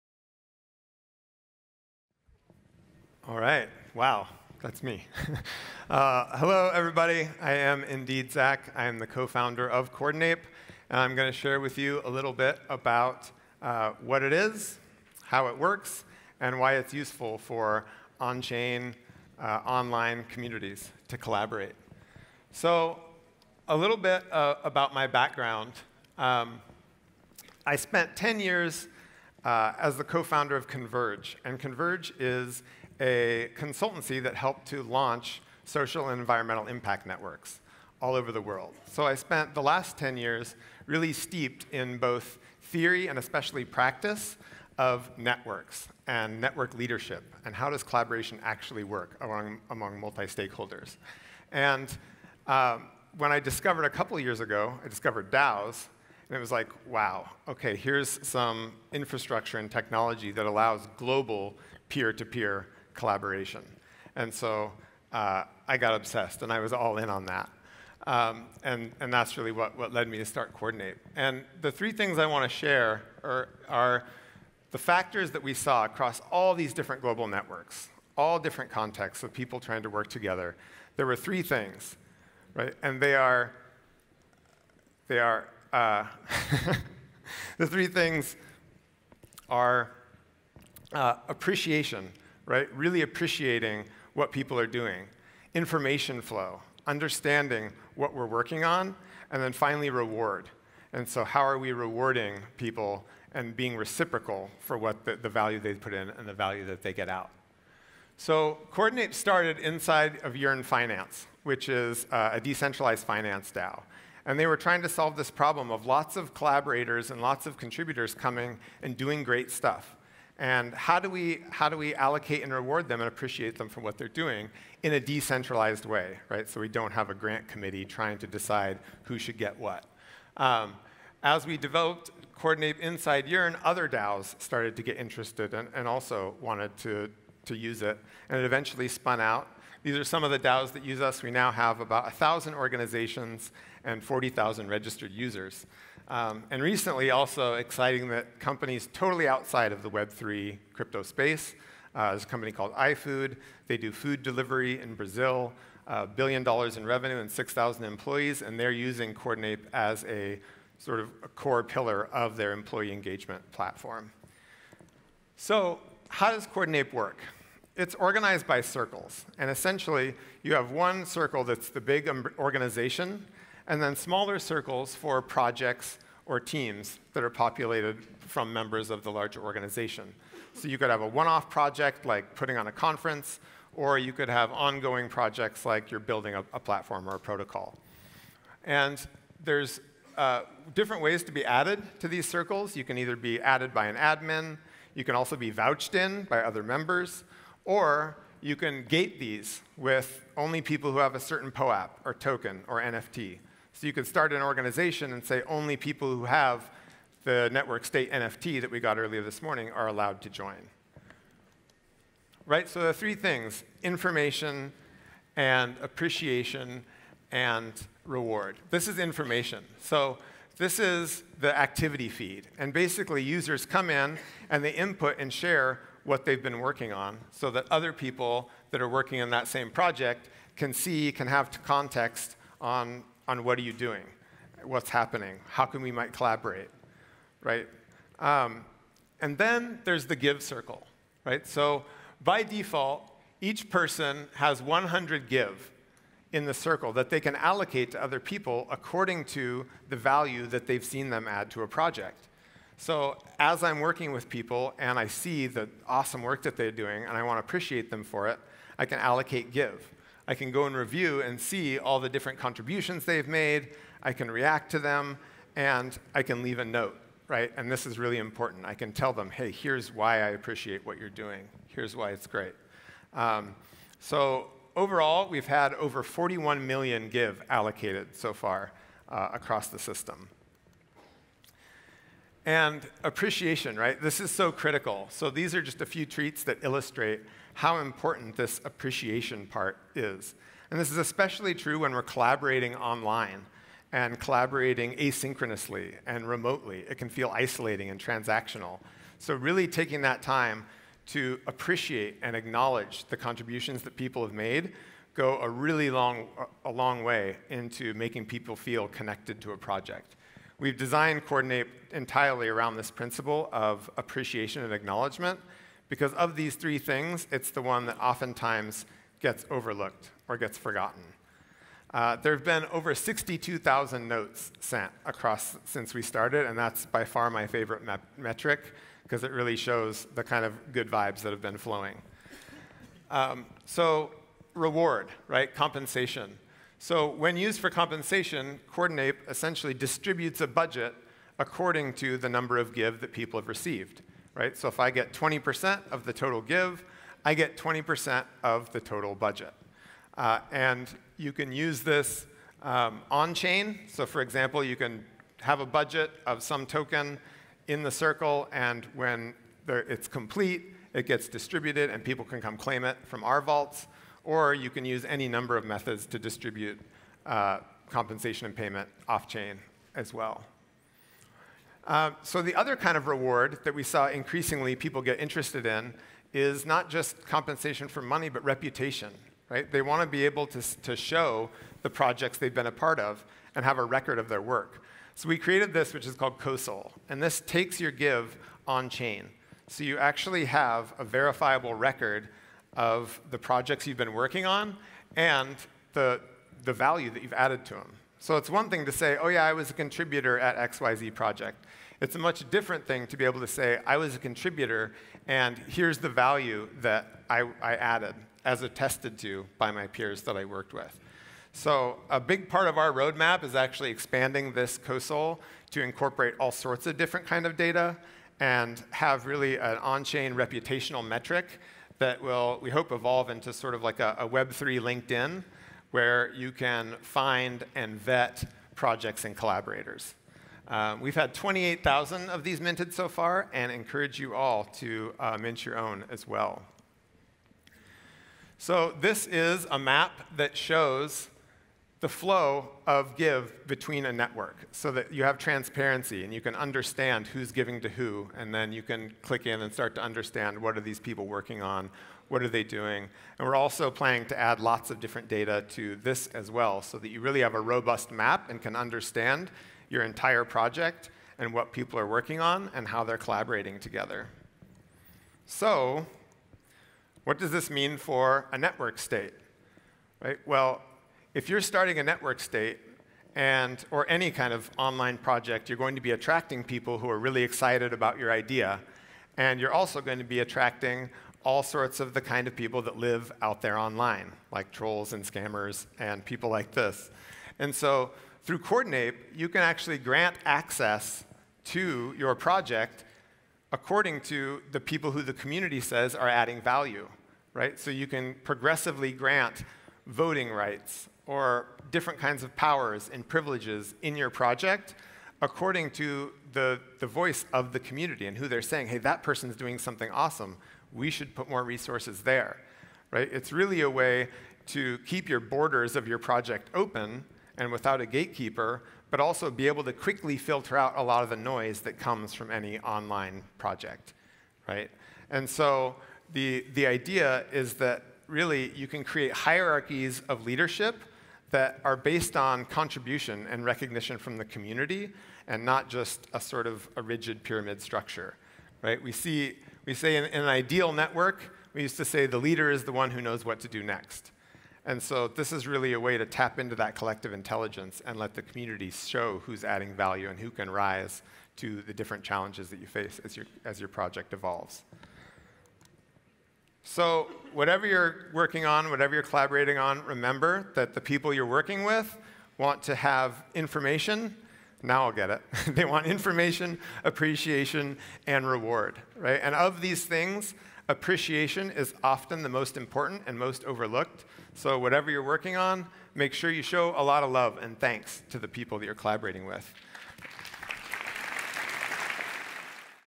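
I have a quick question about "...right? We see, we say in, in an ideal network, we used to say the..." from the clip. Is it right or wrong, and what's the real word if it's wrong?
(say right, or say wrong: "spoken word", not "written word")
right.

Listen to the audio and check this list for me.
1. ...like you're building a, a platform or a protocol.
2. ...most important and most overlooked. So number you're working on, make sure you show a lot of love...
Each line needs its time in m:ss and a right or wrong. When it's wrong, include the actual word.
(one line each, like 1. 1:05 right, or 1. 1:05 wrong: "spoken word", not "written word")
1. 3:05 right
2. 9:32 wrong: "whatever", not "number".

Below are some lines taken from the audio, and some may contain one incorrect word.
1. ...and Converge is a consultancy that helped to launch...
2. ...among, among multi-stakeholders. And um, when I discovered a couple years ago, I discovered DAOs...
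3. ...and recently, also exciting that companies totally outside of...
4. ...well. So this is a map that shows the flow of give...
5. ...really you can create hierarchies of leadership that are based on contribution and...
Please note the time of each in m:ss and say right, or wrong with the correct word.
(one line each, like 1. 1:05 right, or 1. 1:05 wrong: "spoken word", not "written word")
1. 0:31 right
2. 0:49 right
3. 2:26 right
4. 7:16 right
5. 8:48 right.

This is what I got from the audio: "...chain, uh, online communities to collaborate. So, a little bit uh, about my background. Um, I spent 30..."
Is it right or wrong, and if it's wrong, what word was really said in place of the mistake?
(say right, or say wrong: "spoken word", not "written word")
wrong: "10", not "30".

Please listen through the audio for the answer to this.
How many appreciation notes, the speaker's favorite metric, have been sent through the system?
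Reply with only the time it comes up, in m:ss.
5:22.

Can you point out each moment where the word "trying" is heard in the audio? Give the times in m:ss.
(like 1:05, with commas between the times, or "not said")
1:19, 1:54, 2:07.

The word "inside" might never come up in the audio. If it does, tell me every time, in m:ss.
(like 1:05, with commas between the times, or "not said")
1:49, 2:12.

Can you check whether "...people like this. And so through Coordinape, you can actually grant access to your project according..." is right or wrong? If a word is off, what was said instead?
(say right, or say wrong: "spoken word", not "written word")
right.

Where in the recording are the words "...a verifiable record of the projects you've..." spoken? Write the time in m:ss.
6:30.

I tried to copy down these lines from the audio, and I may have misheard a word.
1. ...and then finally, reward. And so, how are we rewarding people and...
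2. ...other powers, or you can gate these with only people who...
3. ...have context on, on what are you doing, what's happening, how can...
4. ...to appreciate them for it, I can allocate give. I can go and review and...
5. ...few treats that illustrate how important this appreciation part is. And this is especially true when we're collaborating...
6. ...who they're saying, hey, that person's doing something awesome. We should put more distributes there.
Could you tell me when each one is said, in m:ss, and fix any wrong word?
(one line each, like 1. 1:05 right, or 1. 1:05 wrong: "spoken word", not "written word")
1. 1:39 right
2. 3:16 wrong: "members", not "powers"
3. 3:51 right
4. 4:17 right
5. 4:45 right
6. 8:28 wrong: "resources", not "distributes".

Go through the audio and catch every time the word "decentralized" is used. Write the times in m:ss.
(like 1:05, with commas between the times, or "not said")
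1:52, 2:04.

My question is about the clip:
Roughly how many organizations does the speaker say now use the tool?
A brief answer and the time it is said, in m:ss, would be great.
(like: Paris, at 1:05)
1,000, at 2:22.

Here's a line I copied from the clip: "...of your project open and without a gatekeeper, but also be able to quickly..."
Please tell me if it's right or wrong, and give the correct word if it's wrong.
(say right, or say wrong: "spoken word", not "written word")
right.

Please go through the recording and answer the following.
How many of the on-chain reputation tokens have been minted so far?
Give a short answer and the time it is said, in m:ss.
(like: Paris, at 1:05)
28,000, at 7:11.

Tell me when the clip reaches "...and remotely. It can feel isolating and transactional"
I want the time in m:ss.
4:56.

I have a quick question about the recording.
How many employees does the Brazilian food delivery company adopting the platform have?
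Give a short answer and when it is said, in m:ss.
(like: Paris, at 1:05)
6,000, at 2:37.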